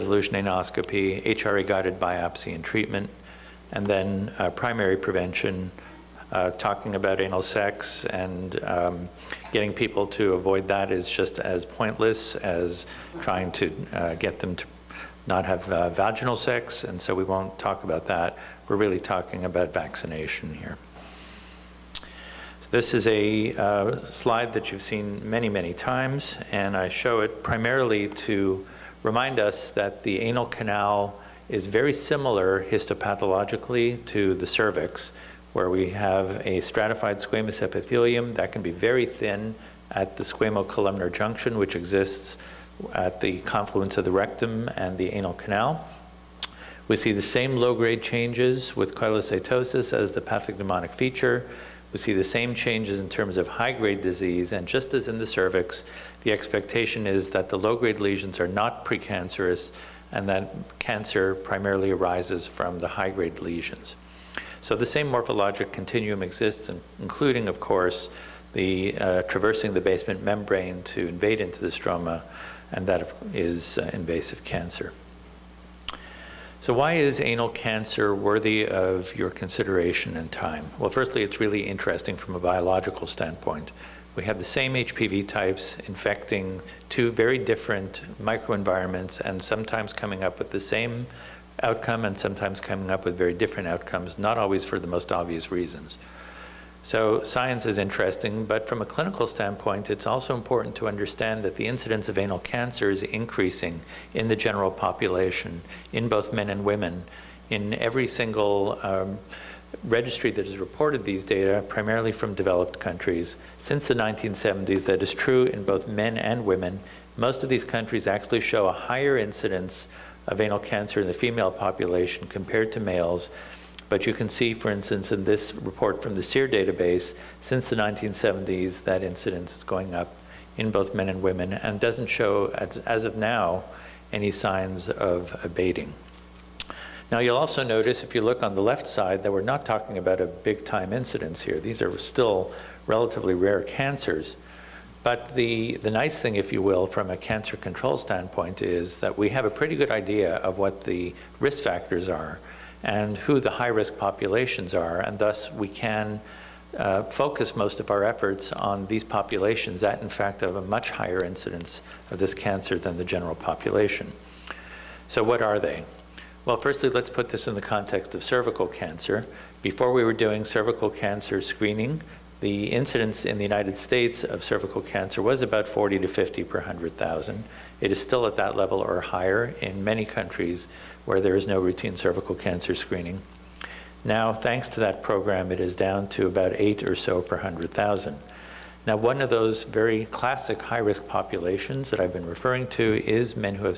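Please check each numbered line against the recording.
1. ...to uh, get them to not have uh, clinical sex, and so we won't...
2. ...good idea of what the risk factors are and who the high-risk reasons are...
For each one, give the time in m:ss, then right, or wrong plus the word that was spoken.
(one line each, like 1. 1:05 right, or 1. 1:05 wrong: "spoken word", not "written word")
1. 0:13 wrong: "vaginal", not "clinical"
2. 2:29 wrong: "populations", not "reasons".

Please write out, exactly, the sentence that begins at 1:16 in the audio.
So why is anal cancer worthy of your consideration and time?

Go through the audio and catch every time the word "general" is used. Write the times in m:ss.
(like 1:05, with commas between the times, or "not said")
1:44, 2:43.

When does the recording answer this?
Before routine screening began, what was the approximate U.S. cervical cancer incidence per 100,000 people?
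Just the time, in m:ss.
2:55.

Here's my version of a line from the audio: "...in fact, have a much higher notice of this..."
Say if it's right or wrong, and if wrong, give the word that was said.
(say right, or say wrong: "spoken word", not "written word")
wrong: "incidence", not "notice".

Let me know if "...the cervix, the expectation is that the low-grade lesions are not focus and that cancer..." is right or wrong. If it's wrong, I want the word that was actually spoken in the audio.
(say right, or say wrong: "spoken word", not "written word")
wrong: "precancerous", not "focus".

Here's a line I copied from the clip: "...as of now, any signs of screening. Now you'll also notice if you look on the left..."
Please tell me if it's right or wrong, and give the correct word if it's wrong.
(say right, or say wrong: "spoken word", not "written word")
wrong: "abating", not "screening".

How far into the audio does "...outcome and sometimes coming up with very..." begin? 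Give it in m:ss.
1:31.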